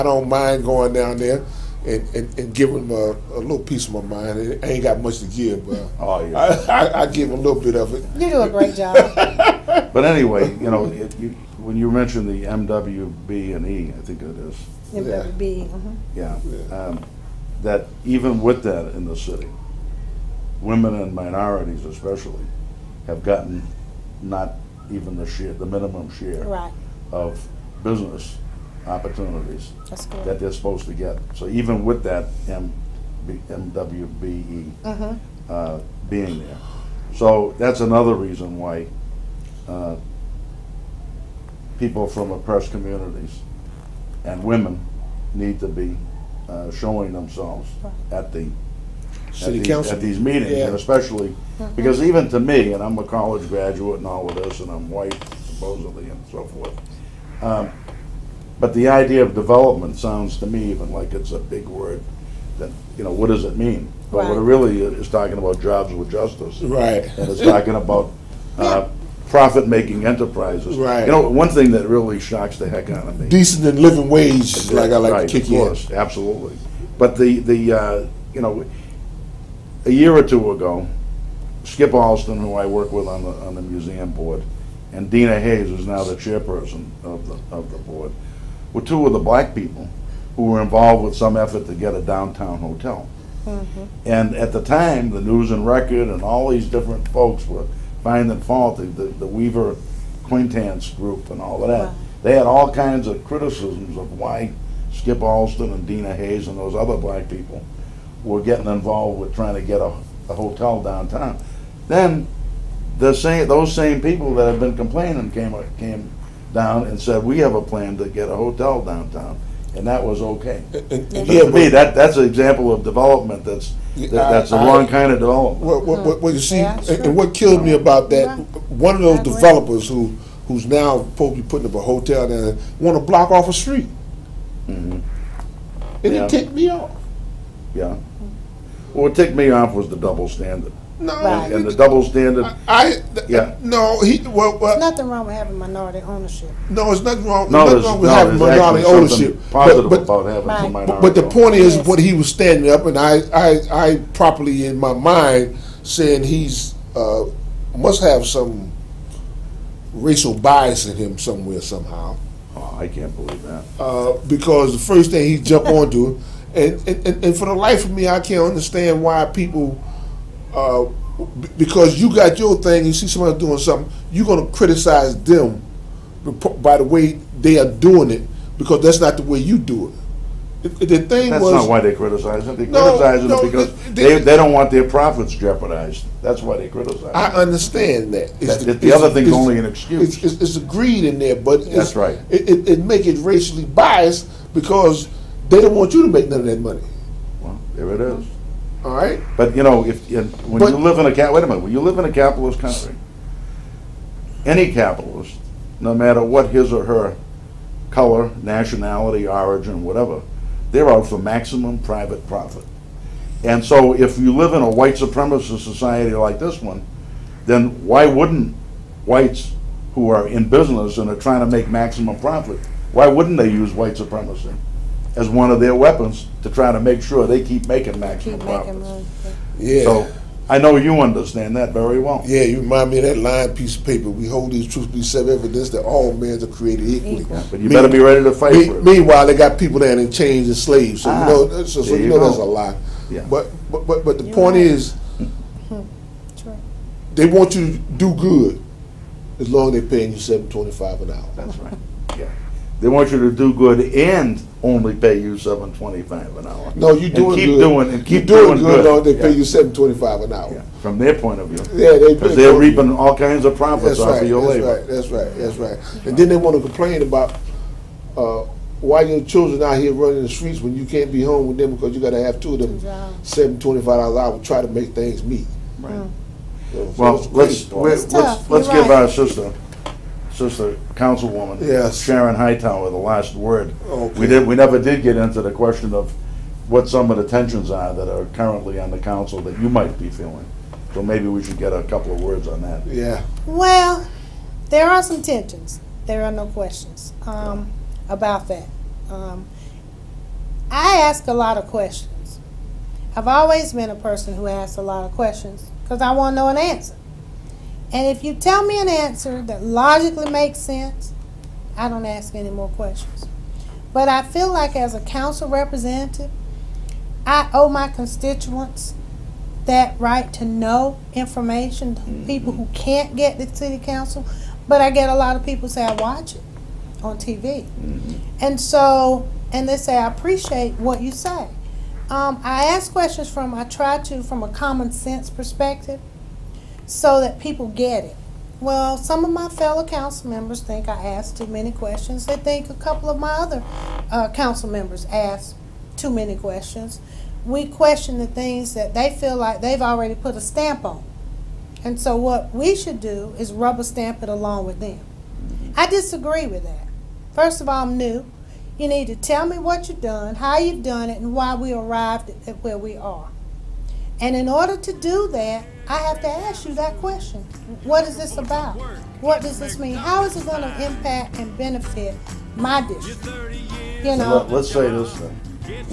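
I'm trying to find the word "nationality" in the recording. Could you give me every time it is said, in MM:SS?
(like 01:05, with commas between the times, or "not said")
03:28.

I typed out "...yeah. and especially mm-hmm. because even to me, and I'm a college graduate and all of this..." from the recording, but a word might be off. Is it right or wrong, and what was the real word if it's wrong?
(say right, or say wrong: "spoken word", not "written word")
right.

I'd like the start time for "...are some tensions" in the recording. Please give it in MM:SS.
04:54.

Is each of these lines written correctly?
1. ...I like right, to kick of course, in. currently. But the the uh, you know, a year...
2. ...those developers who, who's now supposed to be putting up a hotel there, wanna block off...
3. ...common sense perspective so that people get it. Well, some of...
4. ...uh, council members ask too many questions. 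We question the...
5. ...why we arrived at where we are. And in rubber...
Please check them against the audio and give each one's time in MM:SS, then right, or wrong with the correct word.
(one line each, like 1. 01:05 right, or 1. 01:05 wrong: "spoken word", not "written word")
1. 01:14 wrong: "absolutely", not "currently"
2. 02:09 right
3. 05:34 right
4. 05:44 right
5. 06:01 wrong: "order", not "rubber".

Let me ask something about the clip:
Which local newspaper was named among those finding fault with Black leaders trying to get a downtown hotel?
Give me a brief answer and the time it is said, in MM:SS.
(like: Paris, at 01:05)
News and Record, at 01:35.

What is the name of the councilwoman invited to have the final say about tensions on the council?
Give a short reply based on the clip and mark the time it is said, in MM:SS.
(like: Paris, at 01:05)
Sharon Hightower, at 04:42.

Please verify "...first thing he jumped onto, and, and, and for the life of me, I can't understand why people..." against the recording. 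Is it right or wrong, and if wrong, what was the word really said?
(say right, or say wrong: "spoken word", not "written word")
right.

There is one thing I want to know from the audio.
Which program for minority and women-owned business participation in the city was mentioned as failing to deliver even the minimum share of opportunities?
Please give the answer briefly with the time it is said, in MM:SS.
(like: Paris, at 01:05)
MWBE, at 00:33.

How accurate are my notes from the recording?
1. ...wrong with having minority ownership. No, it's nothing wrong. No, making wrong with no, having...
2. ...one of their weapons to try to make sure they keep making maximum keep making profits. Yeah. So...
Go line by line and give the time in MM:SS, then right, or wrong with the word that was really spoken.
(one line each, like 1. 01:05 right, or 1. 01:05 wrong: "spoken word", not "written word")
1. 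02:25 wrong: "nothing", not "making"
2. 03:45 right.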